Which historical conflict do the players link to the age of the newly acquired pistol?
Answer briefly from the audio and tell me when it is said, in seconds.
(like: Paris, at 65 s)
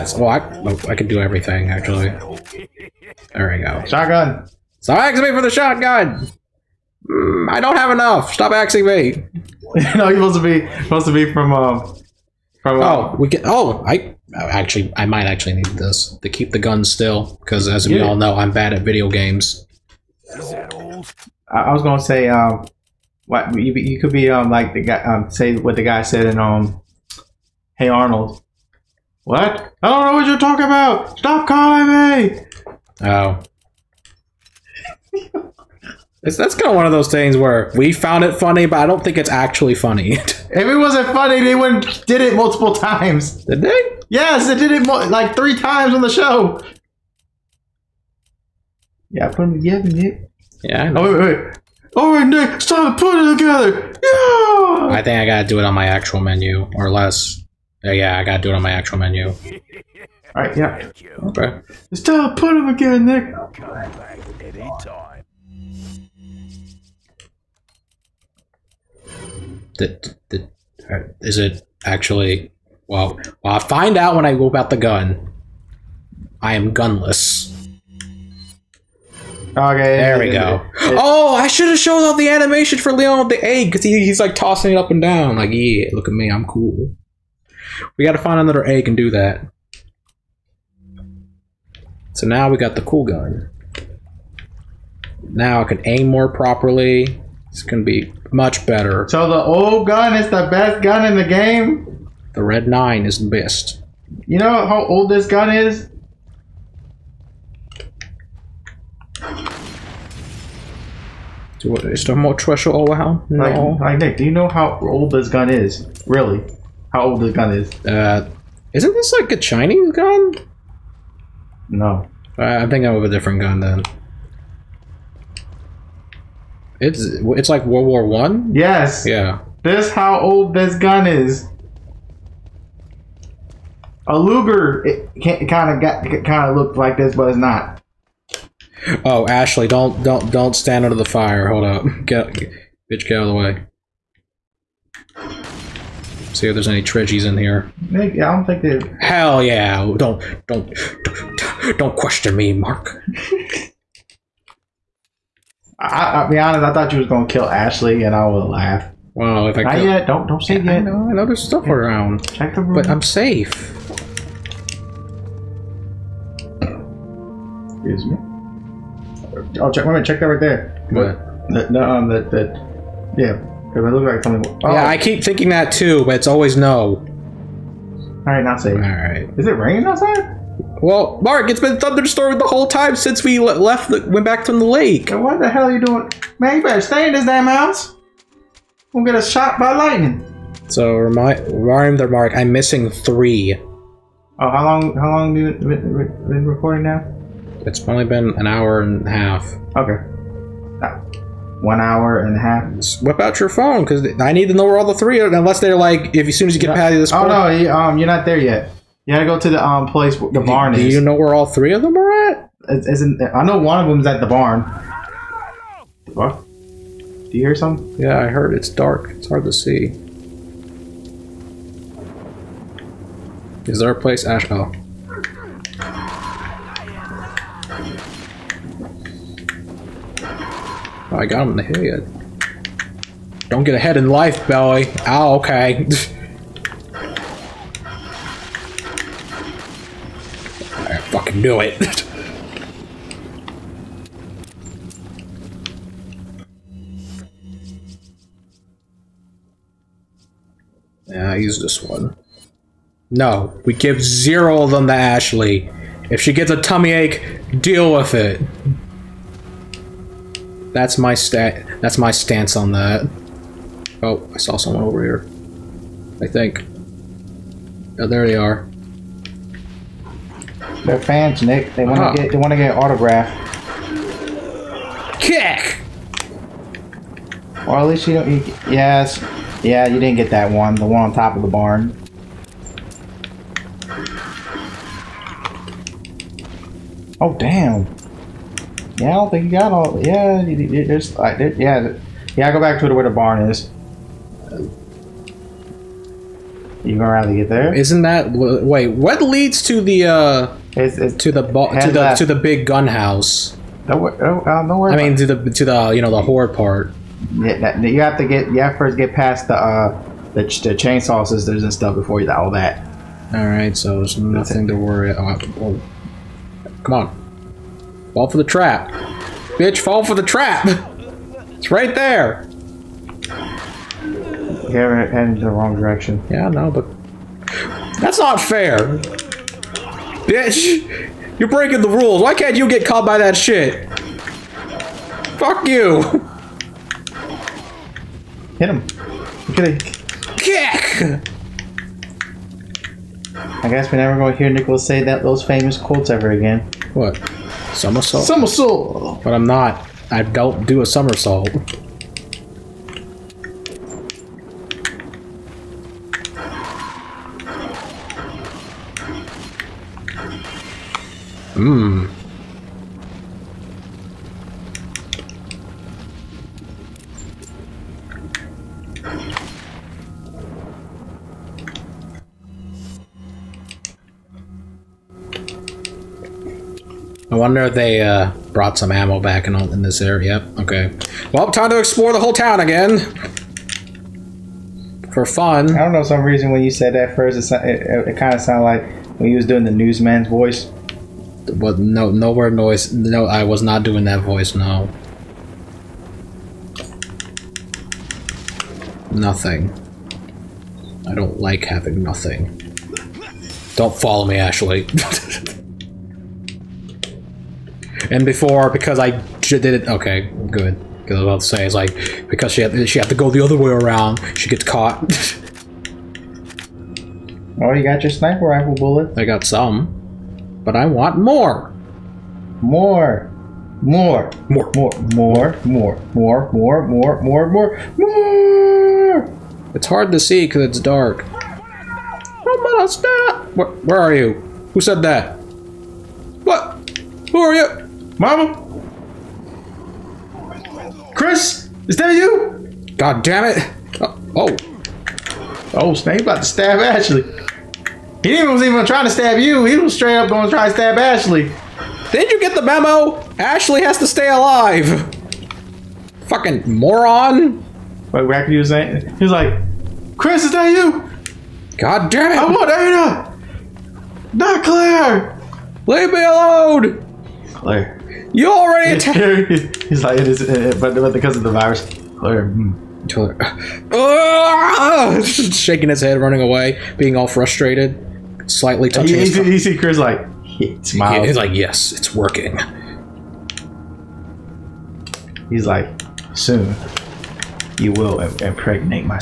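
World War One, at 127 s.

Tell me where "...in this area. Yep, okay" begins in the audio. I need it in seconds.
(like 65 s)
379 s.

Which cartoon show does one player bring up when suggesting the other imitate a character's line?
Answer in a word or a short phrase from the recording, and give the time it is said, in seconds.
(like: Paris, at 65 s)
Hey Arnold, at 27 s.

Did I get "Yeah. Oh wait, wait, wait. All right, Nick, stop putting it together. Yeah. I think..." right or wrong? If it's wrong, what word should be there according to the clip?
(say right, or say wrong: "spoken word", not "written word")
right.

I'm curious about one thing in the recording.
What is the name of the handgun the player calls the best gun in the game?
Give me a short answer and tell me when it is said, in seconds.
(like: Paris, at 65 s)
Red Nine, at 102 s.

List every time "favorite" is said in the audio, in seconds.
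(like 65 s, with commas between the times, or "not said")
not said.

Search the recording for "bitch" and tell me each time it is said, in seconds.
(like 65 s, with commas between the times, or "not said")
142 s, 319 s, 330 s.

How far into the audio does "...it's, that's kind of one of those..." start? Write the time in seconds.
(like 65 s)
36 s.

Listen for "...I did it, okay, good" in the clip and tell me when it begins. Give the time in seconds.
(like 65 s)
408 s.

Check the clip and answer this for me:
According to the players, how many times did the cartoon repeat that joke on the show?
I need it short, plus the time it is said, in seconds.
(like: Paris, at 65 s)
3, at 45 s.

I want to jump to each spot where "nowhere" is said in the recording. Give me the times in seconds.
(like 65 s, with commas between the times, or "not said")
392 s.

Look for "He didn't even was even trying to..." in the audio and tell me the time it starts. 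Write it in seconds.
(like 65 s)
447 s.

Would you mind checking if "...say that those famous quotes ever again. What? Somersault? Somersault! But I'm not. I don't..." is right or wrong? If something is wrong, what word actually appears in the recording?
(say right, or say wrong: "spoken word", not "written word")
right.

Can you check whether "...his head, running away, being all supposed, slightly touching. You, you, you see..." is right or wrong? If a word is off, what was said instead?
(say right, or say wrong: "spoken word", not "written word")
wrong: "frustrated", not "supposed".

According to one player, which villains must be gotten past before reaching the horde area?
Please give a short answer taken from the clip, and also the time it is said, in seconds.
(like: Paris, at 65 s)
The chainsaw sisters, at 310 s.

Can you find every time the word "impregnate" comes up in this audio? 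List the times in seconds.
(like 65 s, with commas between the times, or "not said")
488 s.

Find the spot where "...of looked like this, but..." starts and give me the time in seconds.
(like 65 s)
136 s.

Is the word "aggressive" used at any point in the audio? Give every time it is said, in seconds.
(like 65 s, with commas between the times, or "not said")
not said.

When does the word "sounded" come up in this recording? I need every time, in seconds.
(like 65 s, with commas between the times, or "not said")
388 s.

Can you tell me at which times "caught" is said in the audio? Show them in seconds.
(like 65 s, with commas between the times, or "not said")
332 s, 414 s.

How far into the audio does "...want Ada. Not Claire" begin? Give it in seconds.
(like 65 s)
462 s.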